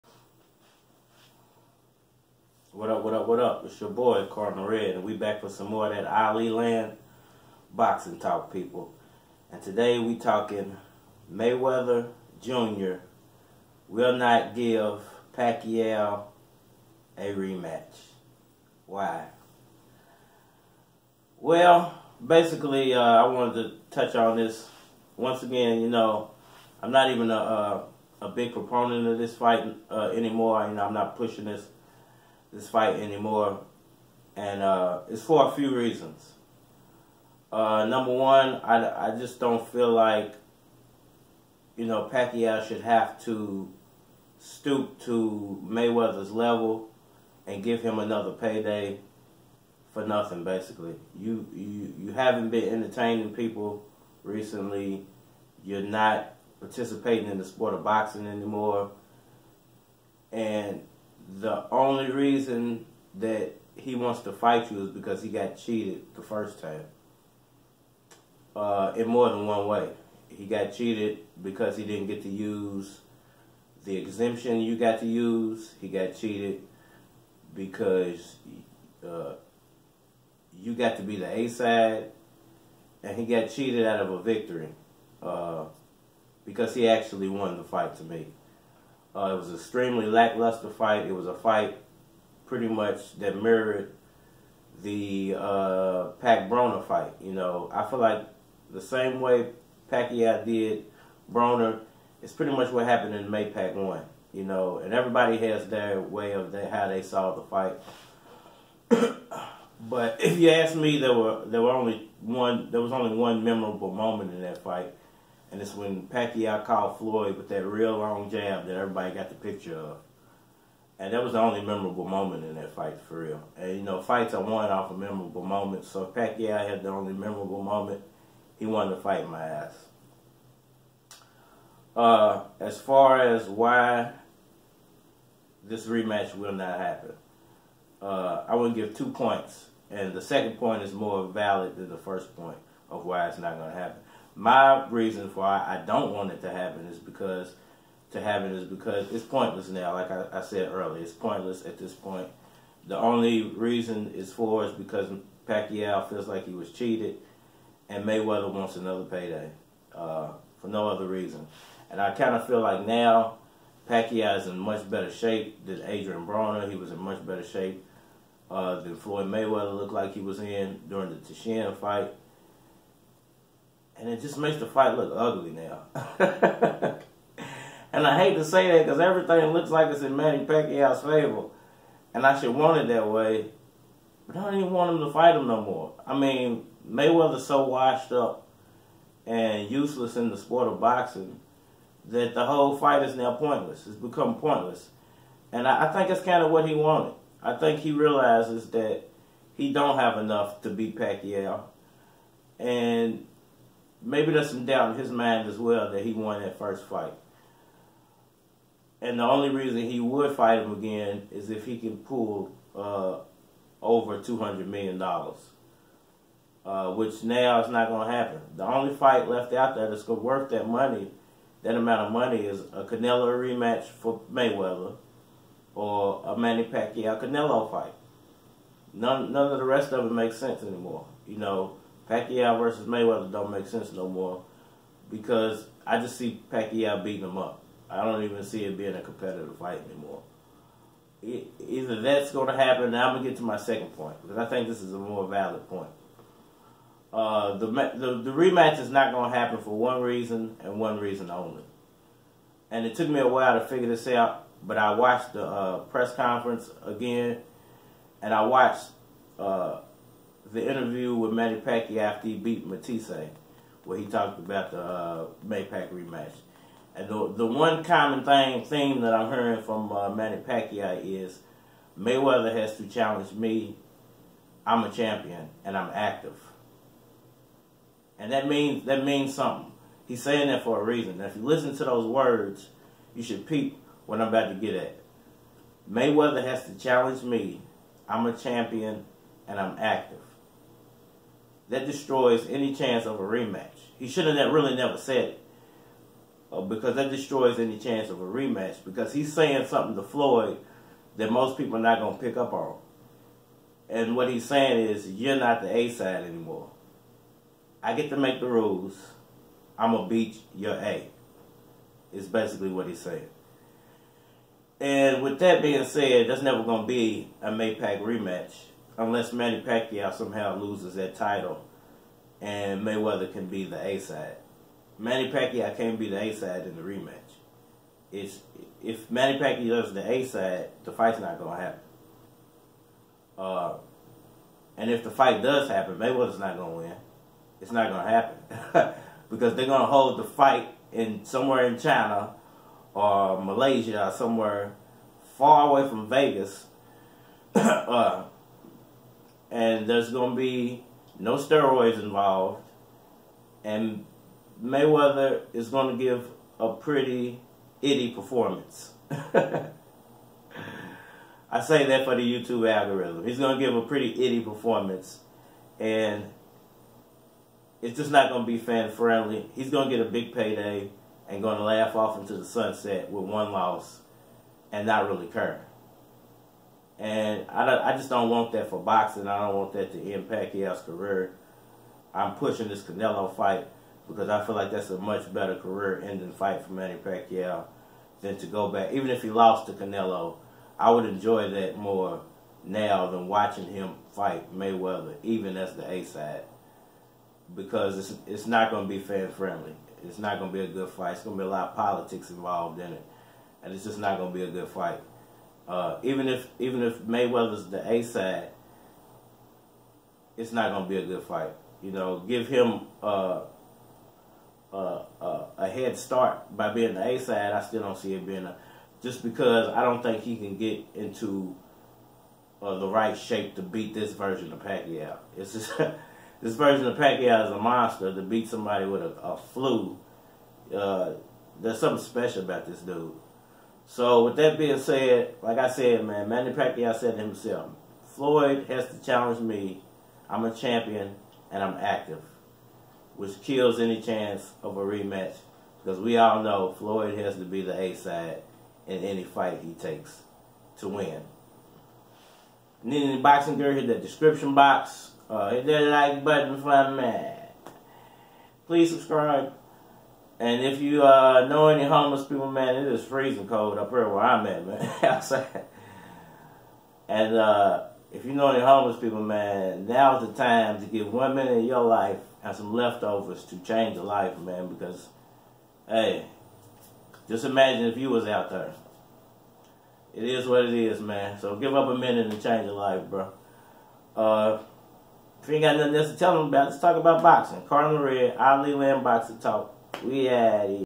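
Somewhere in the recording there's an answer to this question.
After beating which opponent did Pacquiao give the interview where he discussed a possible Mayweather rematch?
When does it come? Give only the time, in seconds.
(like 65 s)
262 s.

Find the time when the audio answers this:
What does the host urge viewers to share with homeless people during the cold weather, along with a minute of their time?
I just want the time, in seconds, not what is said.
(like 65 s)
472 s.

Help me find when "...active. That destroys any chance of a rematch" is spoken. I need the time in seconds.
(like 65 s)
289 s.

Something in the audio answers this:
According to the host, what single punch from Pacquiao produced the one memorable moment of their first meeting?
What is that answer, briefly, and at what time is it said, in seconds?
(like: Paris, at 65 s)
long jab, at 117 s.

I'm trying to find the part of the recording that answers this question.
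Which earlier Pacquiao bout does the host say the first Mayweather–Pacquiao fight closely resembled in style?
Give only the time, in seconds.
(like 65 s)
96 s.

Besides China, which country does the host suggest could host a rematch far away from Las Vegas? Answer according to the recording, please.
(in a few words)
Malaysia.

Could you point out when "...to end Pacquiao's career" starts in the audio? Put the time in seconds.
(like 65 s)
379 s.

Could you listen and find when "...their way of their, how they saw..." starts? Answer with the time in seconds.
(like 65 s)
105 s.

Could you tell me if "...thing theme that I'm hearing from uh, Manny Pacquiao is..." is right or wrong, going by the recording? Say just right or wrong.
right.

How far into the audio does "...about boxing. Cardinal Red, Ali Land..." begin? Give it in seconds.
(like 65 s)
486 s.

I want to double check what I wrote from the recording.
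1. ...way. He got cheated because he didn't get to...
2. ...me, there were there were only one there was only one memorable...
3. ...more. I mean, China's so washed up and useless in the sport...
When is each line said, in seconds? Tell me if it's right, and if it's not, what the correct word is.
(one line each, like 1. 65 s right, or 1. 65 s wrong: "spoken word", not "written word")
1. 69 s right
2. 110 s right
3. 185 s wrong: "Mayweather", not "China".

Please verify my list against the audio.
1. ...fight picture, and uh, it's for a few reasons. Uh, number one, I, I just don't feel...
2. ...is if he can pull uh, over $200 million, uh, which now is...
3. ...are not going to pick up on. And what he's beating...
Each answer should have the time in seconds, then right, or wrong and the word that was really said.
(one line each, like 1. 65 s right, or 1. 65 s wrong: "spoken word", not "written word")
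1. 32 s wrong: "anymore", not "picture"
2. 211 s right
3. 301 s wrong: "saying", not "beating".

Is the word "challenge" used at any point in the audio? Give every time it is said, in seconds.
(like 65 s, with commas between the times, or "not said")
272 s, 286 s, 439 s.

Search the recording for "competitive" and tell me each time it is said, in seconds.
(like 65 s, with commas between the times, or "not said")
239 s.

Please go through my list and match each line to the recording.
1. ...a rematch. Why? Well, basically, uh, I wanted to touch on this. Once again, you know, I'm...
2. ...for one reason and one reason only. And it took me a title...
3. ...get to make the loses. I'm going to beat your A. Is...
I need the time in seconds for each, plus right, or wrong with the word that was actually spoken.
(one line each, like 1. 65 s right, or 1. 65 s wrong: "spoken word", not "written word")
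1. 17 s right
2. 249 s wrong: "while", not "title"
3. 307 s wrong: "rules", not "loses".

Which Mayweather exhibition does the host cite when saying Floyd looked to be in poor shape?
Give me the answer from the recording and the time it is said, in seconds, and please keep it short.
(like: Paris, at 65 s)
Tenshin fight, at 171 s.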